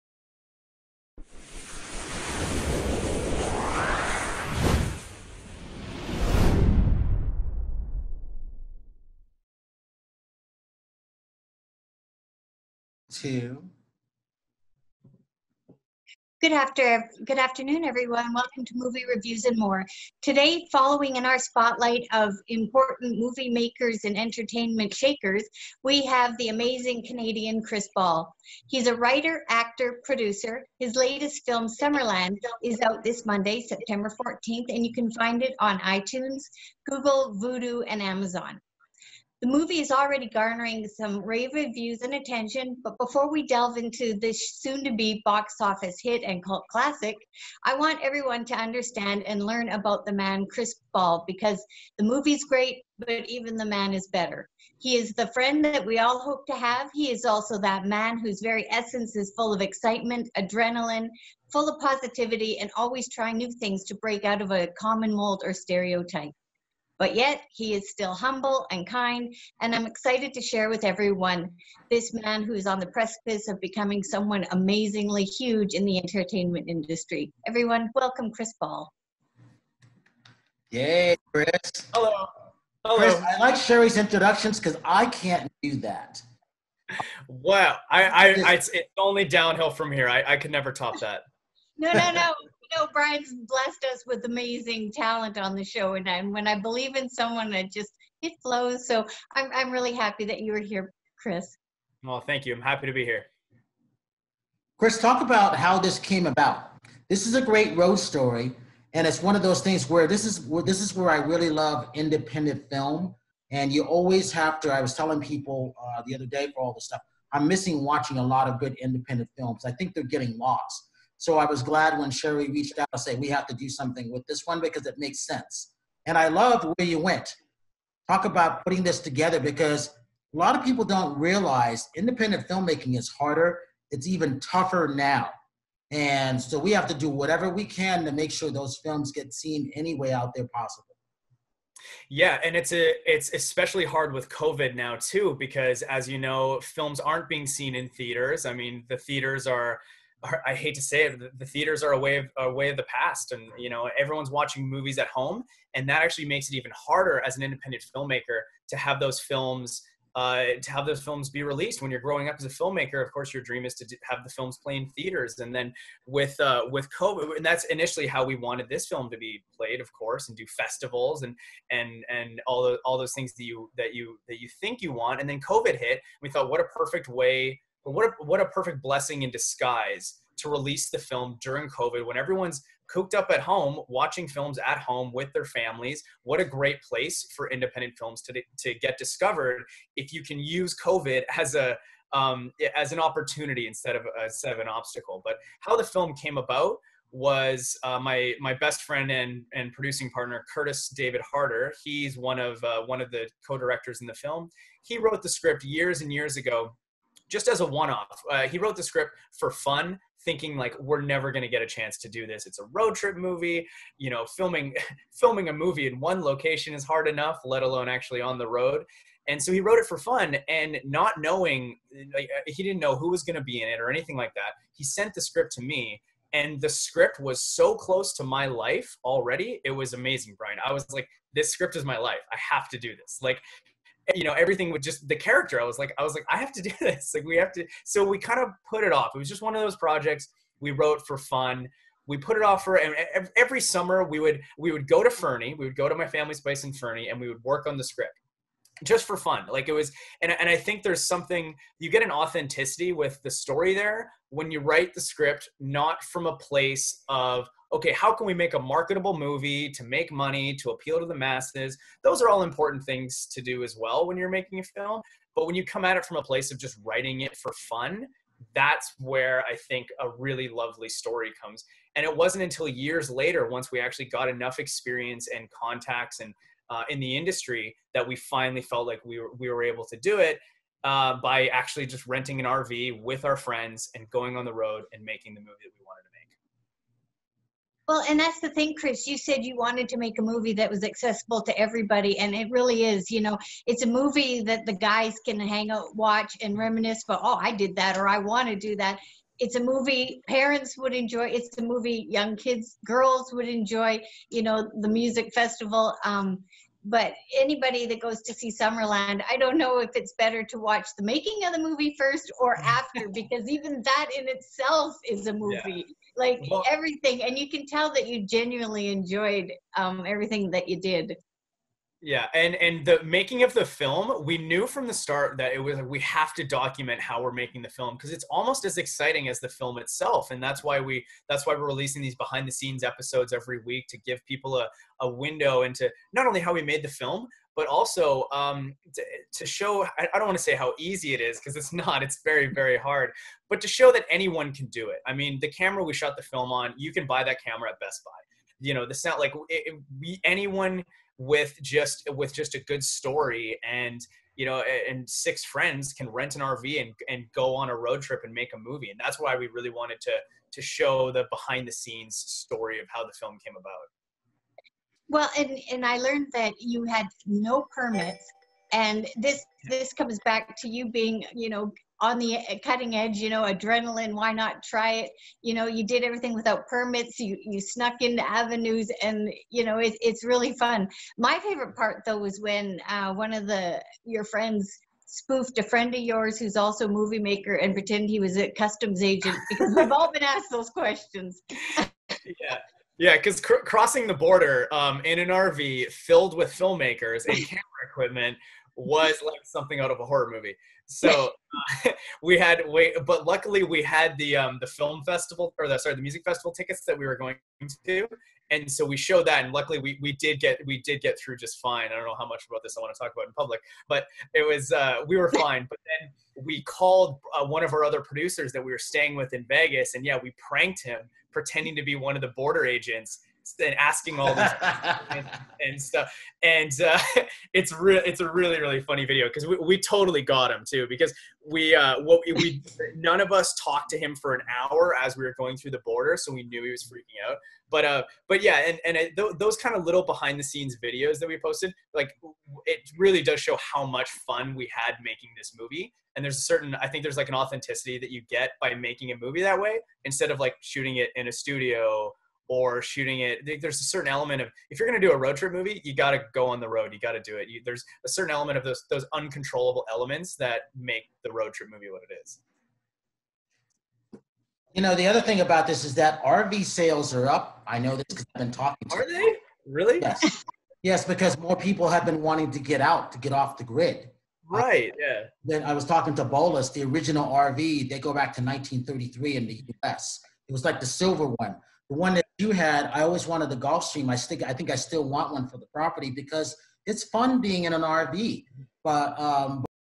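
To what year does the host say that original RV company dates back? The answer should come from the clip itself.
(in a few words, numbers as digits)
1933.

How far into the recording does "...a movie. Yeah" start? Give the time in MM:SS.
05:15.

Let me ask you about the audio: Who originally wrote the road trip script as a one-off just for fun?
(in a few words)
Curtis David Harder.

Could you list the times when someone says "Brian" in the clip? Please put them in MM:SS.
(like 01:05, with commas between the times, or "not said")
01:32, 03:50.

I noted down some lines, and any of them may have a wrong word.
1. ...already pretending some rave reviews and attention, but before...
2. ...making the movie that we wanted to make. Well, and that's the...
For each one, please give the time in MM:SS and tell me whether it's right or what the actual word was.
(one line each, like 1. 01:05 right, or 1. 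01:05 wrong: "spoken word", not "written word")
1. 00:39 wrong: "garnering", not "pretending"
2. 04:45 right.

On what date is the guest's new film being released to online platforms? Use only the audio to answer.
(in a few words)
Monday, September 14th.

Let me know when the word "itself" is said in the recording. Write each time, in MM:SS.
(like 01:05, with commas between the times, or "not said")
05:14, 05:29.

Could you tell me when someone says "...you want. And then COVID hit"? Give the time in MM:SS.
02:54.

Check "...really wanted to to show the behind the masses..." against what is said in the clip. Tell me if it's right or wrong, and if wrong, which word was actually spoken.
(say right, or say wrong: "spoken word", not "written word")
wrong: "scenes", not "masses".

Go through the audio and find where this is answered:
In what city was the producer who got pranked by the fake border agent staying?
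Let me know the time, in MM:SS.
06:59.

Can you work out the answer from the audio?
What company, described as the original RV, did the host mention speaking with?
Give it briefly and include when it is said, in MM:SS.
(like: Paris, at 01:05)
Bowlus, at 07:56.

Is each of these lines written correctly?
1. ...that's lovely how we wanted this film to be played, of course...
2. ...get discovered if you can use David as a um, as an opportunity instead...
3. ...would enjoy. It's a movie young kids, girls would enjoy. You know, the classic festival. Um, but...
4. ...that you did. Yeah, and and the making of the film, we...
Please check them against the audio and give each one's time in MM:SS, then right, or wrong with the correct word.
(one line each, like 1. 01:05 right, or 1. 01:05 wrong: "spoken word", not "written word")
1. 02:47 wrong: "initially", not "lovely"
2. 03:08 wrong: "COVID", not "David"
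3. 05:00 wrong: "music", not "classic"
4. 05:20 right.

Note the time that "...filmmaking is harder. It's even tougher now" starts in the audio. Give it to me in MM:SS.
02:12.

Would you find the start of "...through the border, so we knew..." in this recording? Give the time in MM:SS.
07:15.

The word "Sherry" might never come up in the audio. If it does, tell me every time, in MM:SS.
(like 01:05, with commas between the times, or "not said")
01:23, 02:02.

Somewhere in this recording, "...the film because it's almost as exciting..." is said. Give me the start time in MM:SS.
05:27.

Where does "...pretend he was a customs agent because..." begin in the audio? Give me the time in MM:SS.
06:27.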